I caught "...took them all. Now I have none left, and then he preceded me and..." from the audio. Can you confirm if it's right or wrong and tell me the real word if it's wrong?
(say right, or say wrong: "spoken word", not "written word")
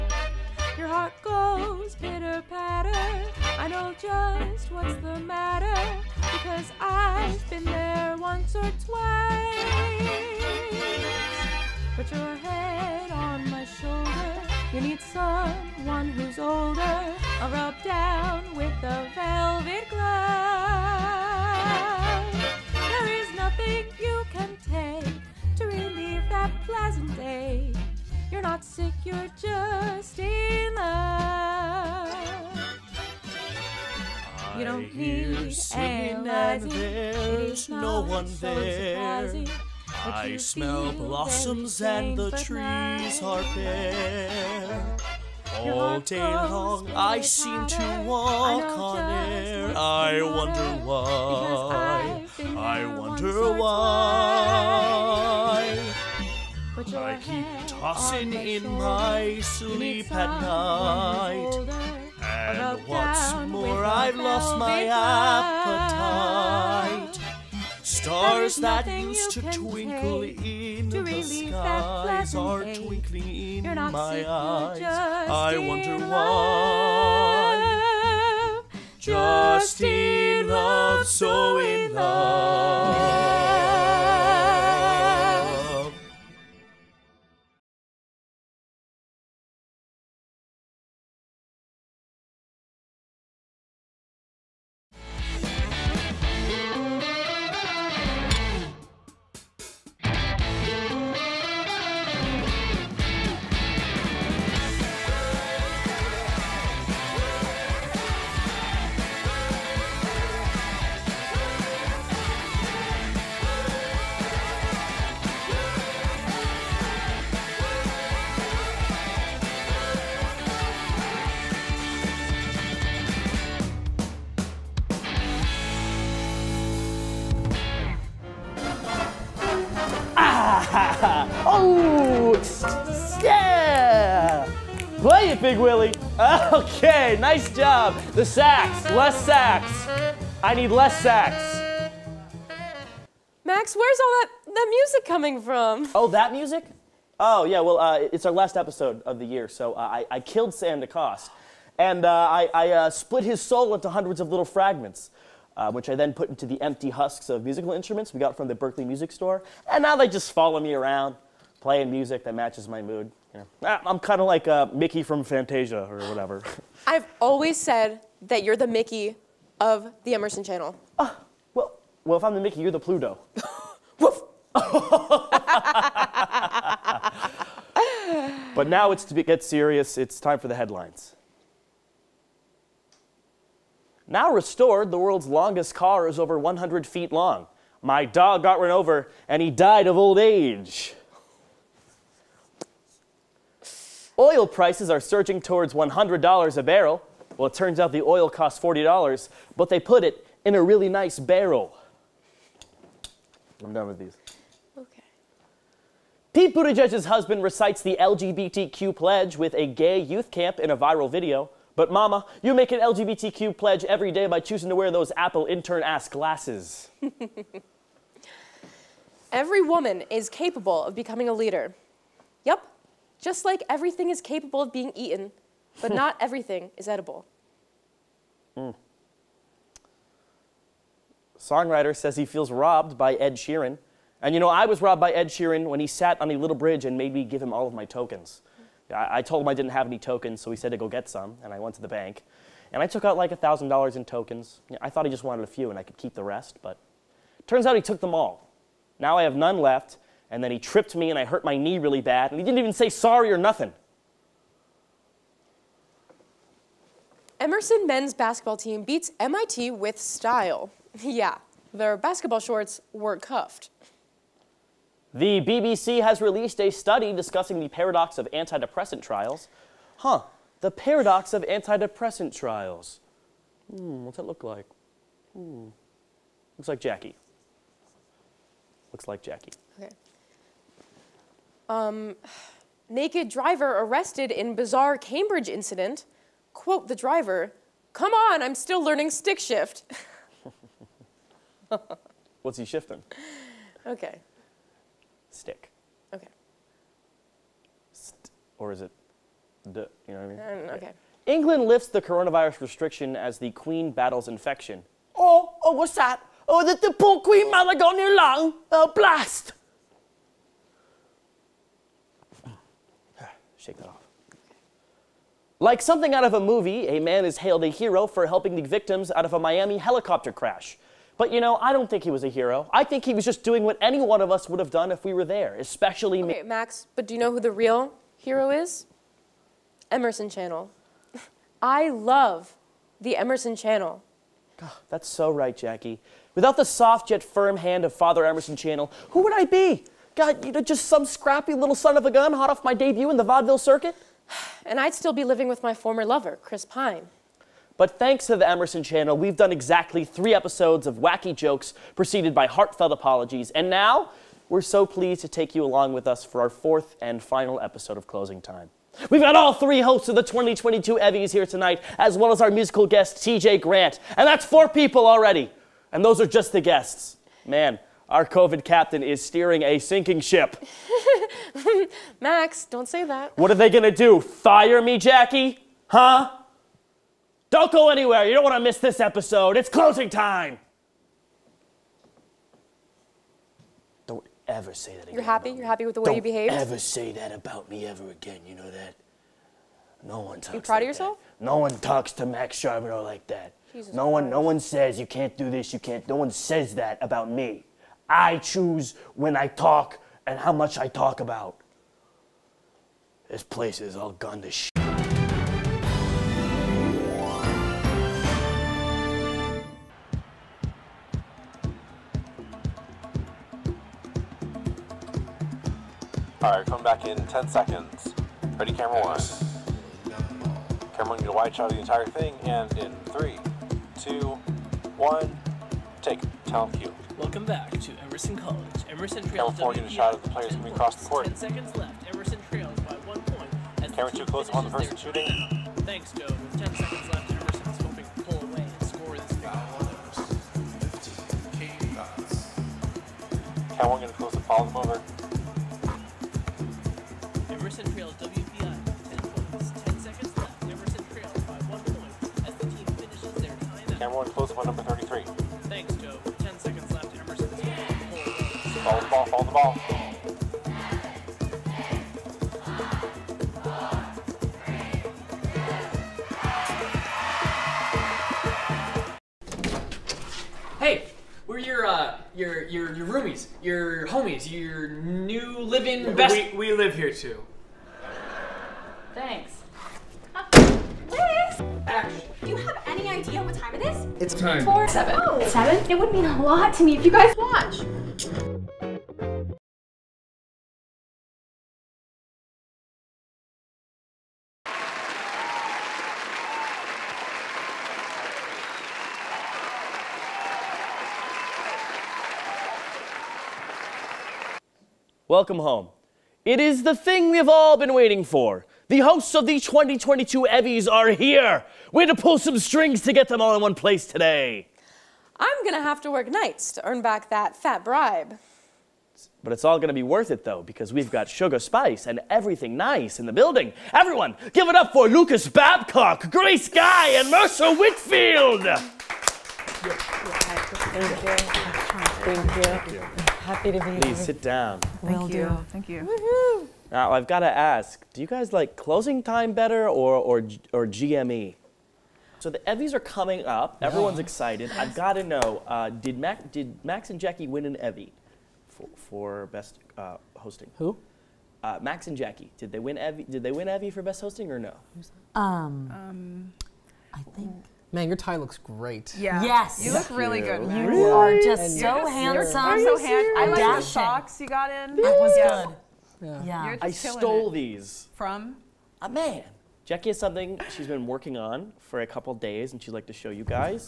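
wrong: "tripped", not "preceded".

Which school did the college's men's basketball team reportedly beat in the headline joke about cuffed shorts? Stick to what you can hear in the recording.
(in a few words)
MIT.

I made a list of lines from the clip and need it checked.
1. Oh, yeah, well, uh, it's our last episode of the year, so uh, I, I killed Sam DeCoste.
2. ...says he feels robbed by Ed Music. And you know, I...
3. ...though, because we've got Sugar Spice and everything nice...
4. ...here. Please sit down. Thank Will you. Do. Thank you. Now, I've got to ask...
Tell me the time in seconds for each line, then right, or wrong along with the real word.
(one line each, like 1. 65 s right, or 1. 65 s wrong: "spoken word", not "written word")
1. 147 s right
2. 231 s wrong: "Sheeran", not "Music"
3. 520 s right
4. 533 s right.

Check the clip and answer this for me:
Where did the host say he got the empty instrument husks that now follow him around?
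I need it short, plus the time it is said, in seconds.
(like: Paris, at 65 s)
Berklee Music Store, at 158 s.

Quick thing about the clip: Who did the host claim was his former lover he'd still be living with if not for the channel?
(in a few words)
Chris Pine.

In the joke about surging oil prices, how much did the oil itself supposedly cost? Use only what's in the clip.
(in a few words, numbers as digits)
$40.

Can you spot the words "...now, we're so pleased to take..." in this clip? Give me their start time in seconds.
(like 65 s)
353 s.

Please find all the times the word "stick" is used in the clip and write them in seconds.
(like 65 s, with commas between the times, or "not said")
289 s, 295 s.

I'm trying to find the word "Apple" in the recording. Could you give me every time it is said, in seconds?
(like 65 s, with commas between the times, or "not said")
215 s.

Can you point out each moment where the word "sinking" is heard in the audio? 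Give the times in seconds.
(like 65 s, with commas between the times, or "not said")
369 s.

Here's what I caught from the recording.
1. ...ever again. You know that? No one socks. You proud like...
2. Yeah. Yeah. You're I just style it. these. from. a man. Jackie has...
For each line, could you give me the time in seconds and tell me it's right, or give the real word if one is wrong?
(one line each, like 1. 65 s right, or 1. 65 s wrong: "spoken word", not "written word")
1. 387 s wrong: "talks", not "socks"
2. 566 s wrong: "stole", not "style".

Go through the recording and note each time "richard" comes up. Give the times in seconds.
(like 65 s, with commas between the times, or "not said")
not said.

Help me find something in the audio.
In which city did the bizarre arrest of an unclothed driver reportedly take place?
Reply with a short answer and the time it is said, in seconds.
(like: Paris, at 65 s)
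Cambridge, at 284 s.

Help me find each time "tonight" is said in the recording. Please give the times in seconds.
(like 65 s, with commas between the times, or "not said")
361 s.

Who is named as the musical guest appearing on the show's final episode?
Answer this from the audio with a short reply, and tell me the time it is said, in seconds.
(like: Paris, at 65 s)
TJ Grant, at 363 s.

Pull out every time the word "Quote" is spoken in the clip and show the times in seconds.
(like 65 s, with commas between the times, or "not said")
286 s.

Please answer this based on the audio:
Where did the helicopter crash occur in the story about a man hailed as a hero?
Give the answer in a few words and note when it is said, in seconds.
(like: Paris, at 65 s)
Miami, at 319 s.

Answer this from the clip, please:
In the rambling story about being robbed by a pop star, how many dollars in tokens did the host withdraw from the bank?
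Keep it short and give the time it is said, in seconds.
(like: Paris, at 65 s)
$1,000, at 243 s.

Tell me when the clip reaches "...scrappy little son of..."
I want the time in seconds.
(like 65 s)
341 s.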